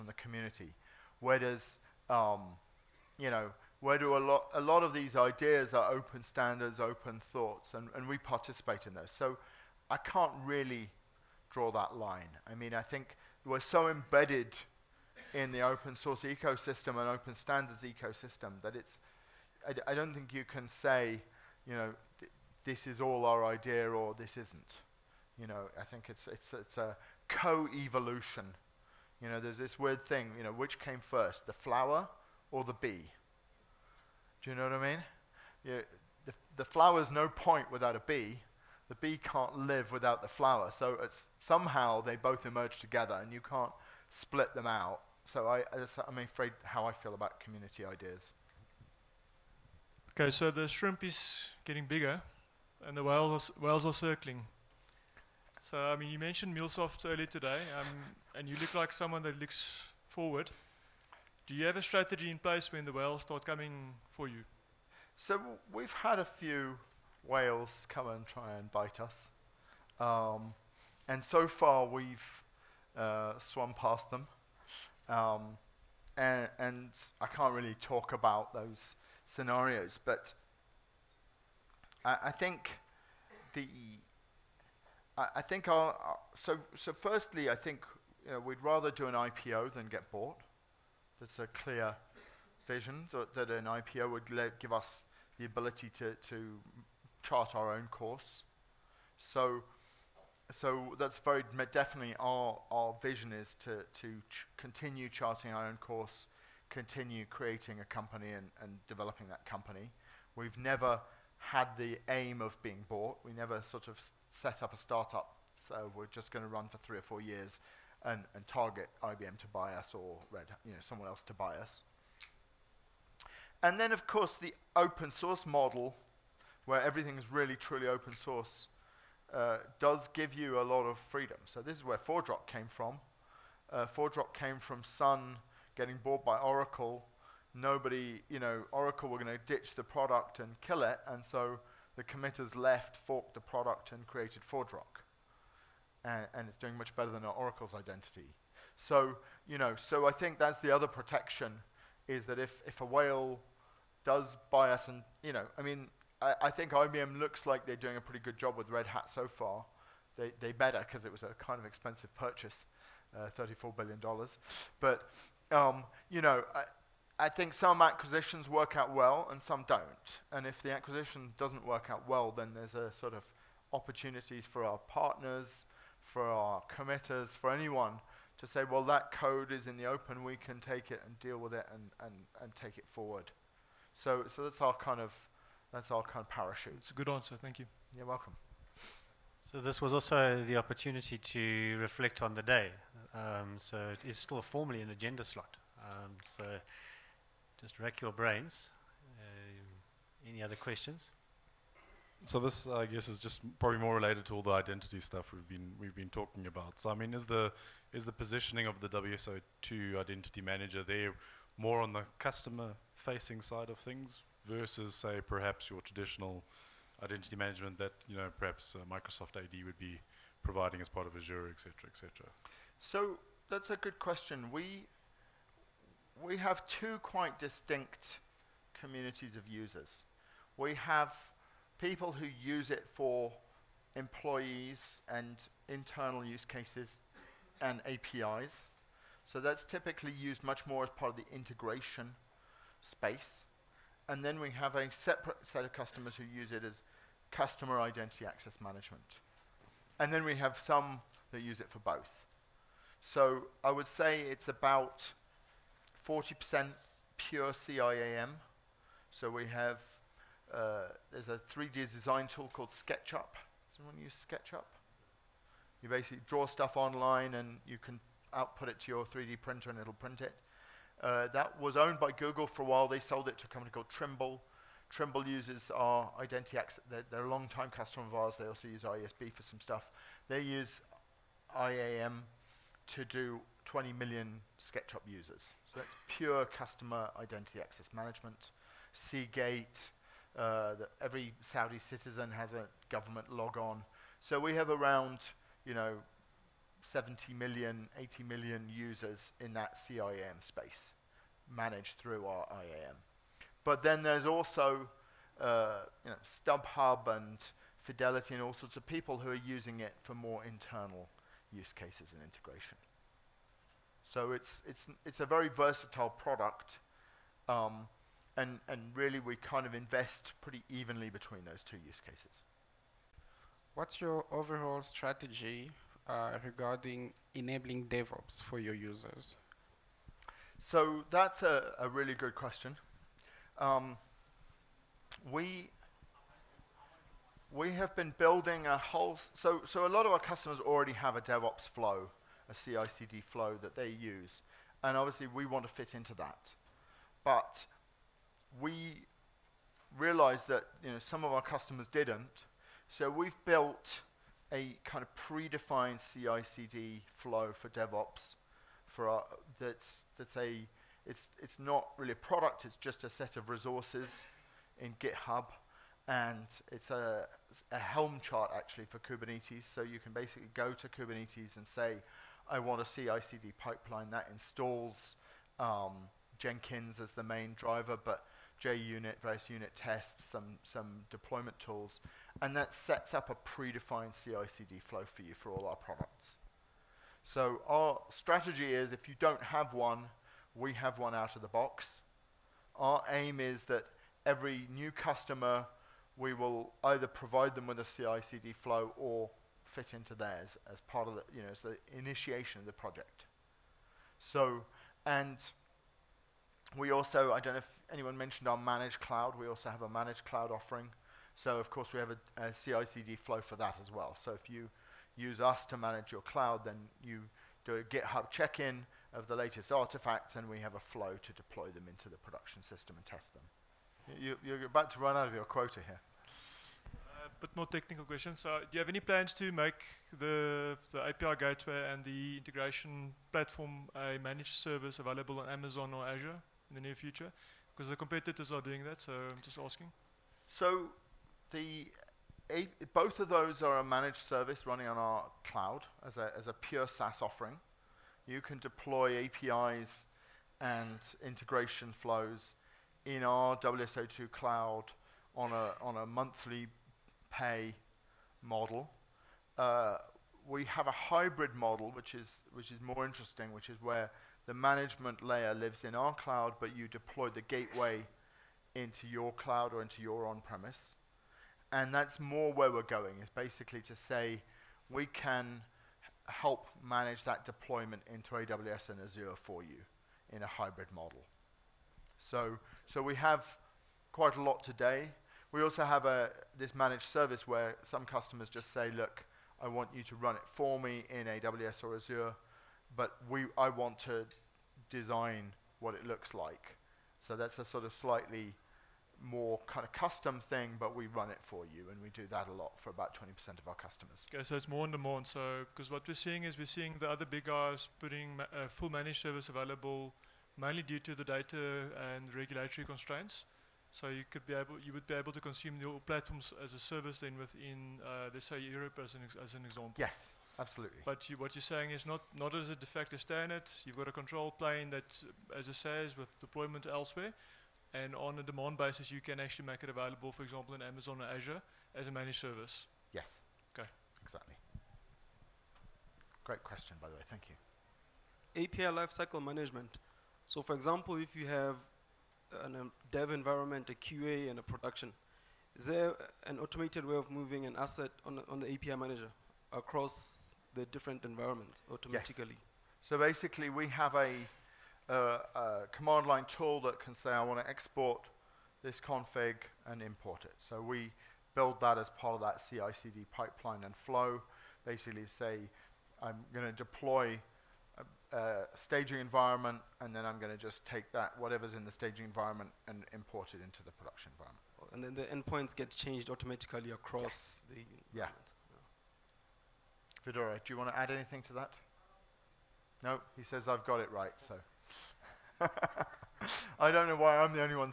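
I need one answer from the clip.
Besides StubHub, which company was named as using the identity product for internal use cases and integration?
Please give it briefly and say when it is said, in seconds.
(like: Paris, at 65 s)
Fidelity, at 307 s.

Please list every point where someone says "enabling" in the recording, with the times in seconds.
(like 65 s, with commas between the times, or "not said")
327 s.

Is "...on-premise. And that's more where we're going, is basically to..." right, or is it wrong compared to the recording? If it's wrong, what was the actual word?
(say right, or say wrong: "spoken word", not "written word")
right.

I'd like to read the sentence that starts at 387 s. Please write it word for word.
So our strategy is if you don't have one, we have one out of the box.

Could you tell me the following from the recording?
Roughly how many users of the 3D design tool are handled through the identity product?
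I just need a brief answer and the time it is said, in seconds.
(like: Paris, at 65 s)
20 million, at 283 s.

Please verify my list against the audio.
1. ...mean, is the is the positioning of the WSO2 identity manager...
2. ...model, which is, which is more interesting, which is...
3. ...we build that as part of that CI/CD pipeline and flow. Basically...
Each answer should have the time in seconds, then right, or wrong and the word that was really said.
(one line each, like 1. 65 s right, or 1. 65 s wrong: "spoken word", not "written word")
1. 206 s right
2. 461 s right
3. 560 s right.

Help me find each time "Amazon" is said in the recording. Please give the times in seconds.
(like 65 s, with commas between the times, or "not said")
435 s, 530 s.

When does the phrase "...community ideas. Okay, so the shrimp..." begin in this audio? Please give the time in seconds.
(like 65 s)
47 s.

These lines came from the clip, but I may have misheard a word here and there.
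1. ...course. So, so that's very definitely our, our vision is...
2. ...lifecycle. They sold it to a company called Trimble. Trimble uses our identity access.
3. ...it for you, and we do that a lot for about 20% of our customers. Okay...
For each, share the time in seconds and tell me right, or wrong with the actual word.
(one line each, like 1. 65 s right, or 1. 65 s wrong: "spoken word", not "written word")
1. 97 s right
2. 272 s wrong: "while", not "lifecycle"
3. 501 s right.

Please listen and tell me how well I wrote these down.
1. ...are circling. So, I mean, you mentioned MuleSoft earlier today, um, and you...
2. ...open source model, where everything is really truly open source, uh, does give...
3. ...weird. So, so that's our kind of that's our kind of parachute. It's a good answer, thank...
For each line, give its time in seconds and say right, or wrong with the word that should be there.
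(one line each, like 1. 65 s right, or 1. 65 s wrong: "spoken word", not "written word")
1. 53 s right
2. 124 s right
3. 182 s wrong: "forward", not "weird".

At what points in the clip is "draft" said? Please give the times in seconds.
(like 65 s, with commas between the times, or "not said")
not said.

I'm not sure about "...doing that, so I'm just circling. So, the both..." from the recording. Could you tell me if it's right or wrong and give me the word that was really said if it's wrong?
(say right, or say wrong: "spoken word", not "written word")
wrong: "asking", not "circling".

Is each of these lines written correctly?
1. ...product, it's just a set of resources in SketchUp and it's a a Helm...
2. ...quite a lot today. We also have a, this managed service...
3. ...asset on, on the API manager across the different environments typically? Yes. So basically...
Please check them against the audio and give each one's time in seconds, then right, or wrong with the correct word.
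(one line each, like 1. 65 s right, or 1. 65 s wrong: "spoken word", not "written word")
1. 362 s wrong: "GitHub", not "SketchUp"
2. 484 s right
3. 547 s wrong: "automatically", not "typically".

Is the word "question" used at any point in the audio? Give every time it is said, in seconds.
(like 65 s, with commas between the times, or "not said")
200 s, 223 s, 332 s, 428 s, 536 s.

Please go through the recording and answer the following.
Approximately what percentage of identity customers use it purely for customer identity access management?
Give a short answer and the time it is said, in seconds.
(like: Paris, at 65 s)
40%, at 256 s.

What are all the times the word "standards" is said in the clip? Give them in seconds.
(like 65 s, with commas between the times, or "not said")
6 s, 17 s, 523 s.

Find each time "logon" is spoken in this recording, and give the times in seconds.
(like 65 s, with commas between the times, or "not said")
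293 s.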